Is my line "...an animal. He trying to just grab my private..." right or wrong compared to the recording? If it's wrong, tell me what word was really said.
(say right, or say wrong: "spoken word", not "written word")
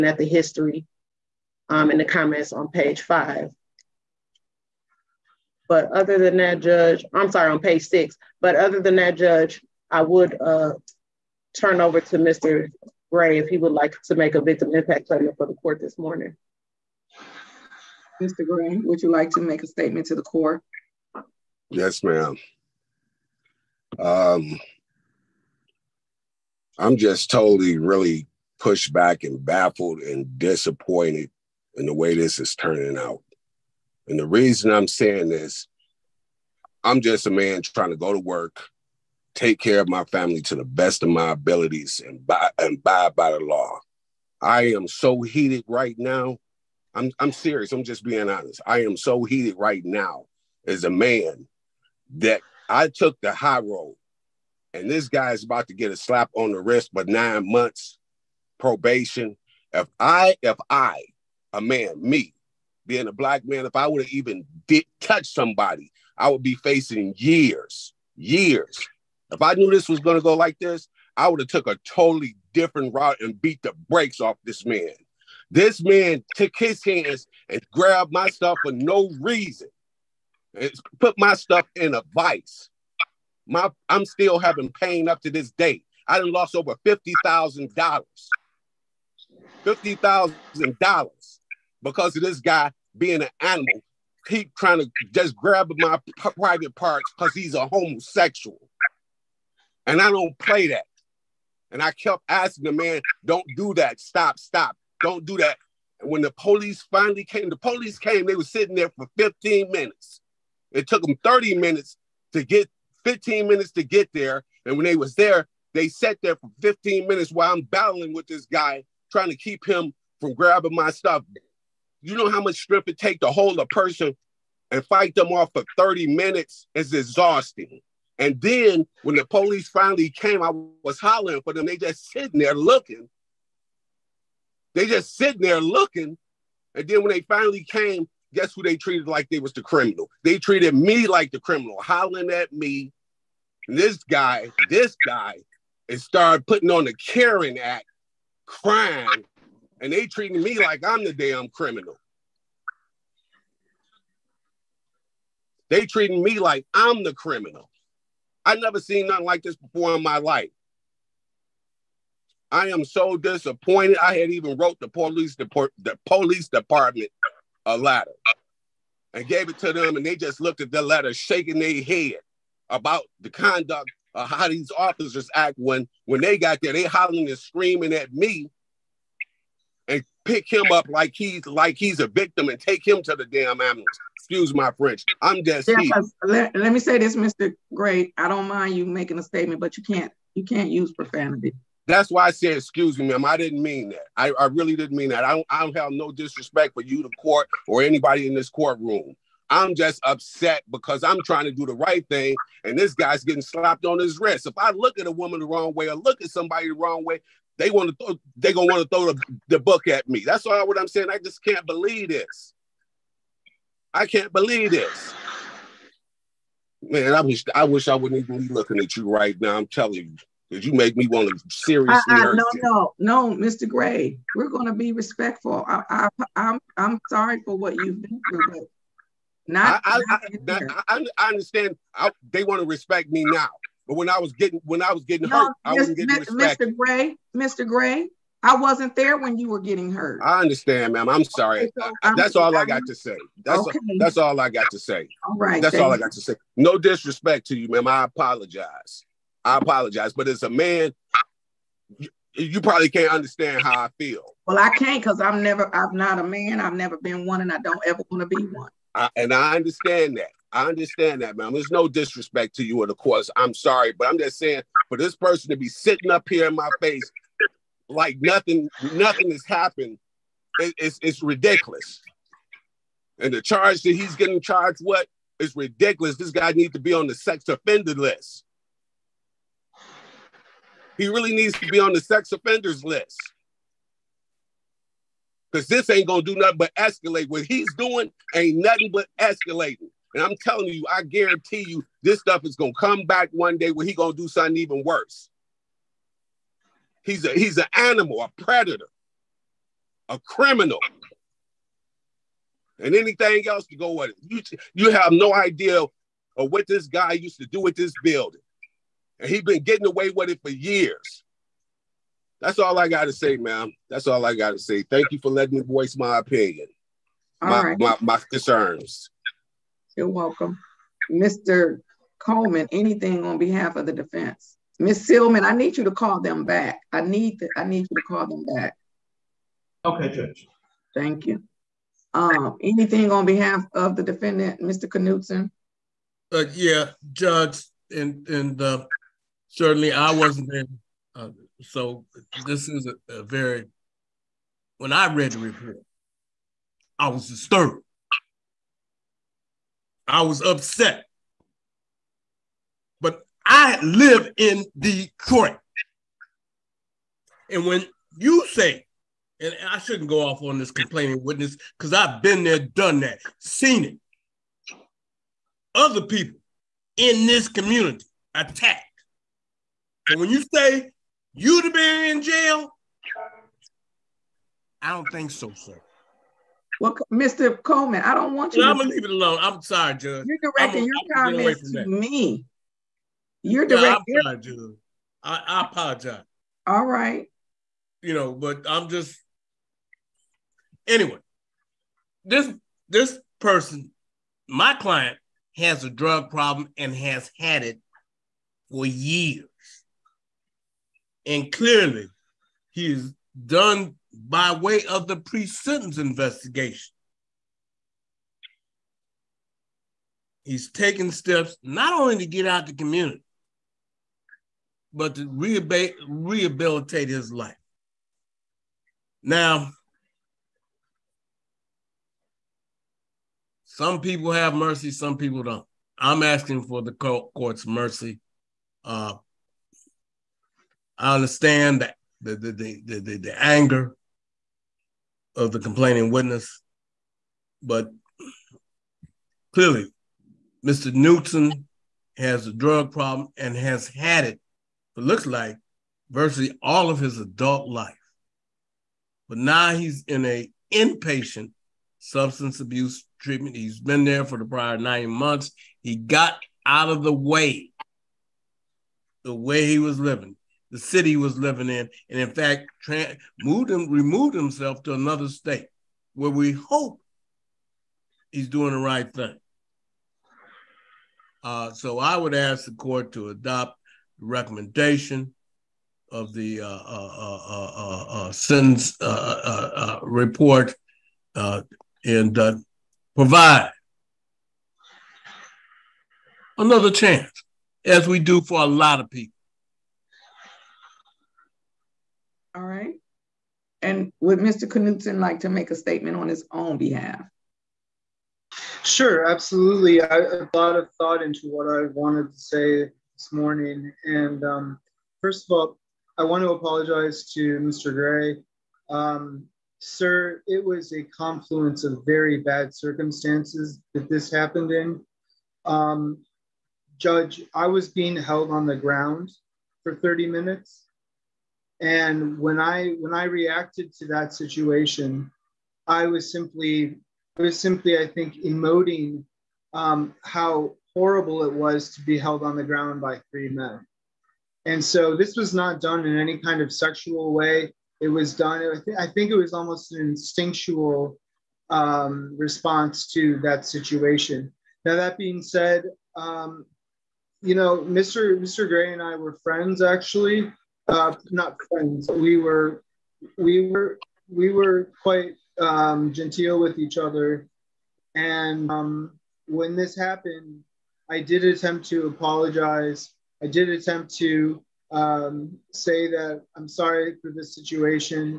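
right.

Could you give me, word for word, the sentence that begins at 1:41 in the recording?
And I kept asking the man, "Don't do that.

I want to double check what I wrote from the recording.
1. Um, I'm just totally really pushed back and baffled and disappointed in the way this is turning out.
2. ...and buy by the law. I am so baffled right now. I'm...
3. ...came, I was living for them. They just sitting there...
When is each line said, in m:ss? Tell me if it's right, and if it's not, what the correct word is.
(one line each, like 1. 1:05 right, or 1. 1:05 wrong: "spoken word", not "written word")
1. 0:23 right
2. 0:42 wrong: "heated", not "baffled"
3. 2:10 wrong: "hollering", not "living".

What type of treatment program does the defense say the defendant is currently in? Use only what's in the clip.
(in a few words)
Inpatient substance abuse treatment.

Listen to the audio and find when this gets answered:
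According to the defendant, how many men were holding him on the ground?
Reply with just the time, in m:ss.
8:53.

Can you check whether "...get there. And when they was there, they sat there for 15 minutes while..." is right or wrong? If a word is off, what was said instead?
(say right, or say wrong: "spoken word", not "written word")
right.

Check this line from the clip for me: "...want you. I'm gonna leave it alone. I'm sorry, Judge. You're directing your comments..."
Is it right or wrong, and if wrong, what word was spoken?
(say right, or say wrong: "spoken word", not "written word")
right.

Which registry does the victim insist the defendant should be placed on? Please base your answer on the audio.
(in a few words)
Sex offender list.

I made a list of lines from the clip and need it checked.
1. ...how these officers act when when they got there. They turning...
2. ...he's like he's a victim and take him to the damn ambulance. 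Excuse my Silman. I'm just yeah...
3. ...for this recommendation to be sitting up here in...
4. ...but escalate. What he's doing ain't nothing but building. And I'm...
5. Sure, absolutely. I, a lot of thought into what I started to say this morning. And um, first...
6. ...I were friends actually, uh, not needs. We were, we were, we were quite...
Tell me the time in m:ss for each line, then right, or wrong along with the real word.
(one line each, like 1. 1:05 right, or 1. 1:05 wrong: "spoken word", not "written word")
1. 2:54 wrong: "hollering", not "turning"
2. 3:01 wrong: "French", not "Silman"
3. 4:24 wrong: "person", not "recommendation"
4. 4:46 wrong: "escalating", not "building"
5. 8:18 wrong: "wanted", not "started"
6. 9:09 wrong: "friends", not "needs".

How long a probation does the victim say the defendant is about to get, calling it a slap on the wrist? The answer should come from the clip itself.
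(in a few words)
9 months.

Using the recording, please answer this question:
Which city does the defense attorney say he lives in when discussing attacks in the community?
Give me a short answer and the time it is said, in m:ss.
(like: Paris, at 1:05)
Detroit, at 5:54.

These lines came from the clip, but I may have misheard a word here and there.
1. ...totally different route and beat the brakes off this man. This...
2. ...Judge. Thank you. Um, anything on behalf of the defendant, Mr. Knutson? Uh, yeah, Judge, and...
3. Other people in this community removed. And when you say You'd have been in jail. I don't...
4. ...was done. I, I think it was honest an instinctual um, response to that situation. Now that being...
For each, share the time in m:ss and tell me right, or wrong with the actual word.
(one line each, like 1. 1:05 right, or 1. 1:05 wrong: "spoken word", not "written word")
1. 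1:11 right
2. 5:30 right
3. 6:05 wrong: "attacked", not "removed"
4. 8:58 wrong: "almost", not "honest".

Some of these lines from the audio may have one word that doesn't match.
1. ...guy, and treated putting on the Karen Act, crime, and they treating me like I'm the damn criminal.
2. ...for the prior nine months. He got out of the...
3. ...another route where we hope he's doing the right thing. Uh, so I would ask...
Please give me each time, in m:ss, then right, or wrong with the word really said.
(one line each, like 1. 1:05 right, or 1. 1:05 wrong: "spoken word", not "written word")
1. 2:25 wrong: "started", not "treated"
2. 7:34 right
3. 7:44 wrong: "state", not "route".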